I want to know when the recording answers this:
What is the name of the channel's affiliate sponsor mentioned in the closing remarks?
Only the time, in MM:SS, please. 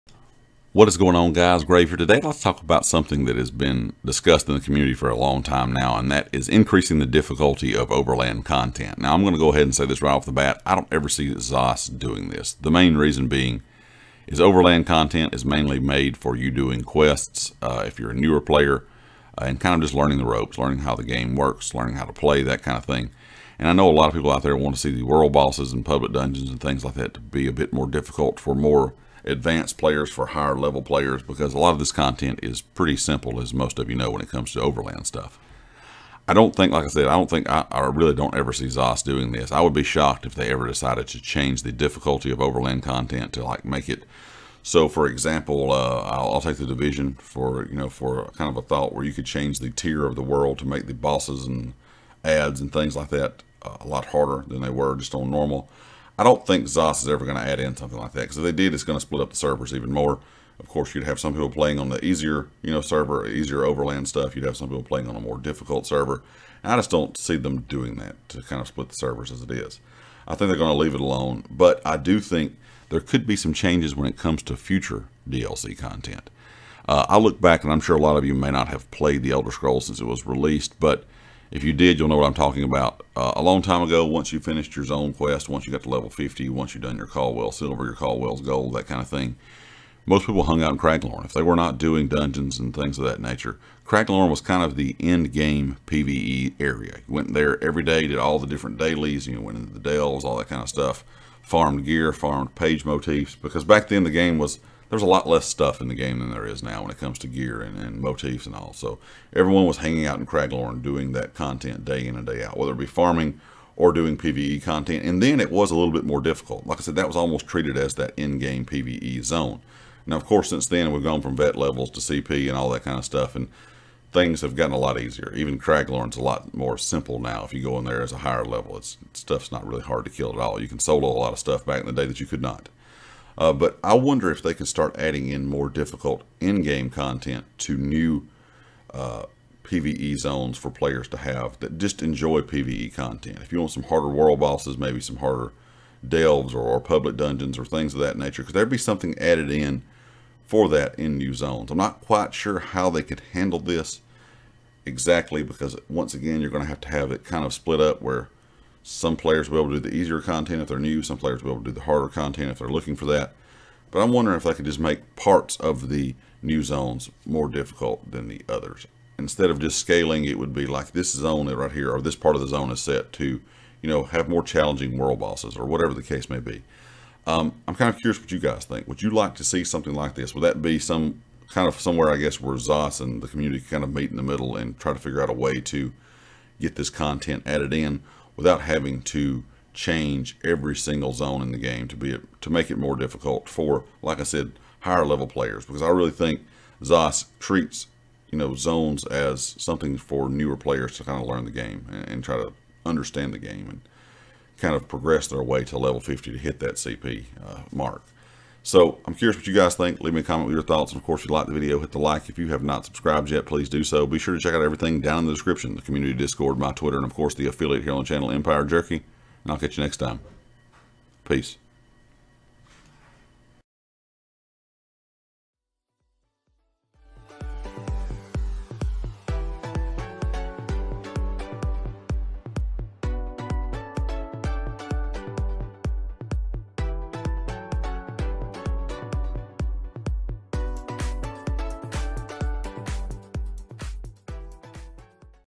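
03:38.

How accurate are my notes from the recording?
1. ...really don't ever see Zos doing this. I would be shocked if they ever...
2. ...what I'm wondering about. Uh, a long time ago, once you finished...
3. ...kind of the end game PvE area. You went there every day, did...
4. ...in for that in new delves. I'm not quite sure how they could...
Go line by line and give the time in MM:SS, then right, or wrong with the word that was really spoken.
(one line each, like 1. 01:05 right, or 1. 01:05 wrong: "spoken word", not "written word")
1. 00:37 right
2. 01:22 wrong: "talking", not "wondering"
3. 01:34 right
4. 02:29 wrong: "zones", not "delves".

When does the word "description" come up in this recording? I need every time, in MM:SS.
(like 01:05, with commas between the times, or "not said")
03:35.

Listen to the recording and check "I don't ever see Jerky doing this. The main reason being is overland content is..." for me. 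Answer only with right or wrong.
wrong.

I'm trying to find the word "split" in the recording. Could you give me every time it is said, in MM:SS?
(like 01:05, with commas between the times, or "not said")
00:59, 01:08, 02:37.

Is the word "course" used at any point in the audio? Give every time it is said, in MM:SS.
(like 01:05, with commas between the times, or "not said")
01:00, 02:00, 03:31, 03:37.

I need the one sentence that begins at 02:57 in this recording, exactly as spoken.
Um, I'm kind of curious what you guys think.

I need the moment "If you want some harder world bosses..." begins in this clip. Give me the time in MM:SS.
02:23.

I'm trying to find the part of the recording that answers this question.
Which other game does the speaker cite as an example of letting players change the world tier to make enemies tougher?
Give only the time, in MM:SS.
00:46.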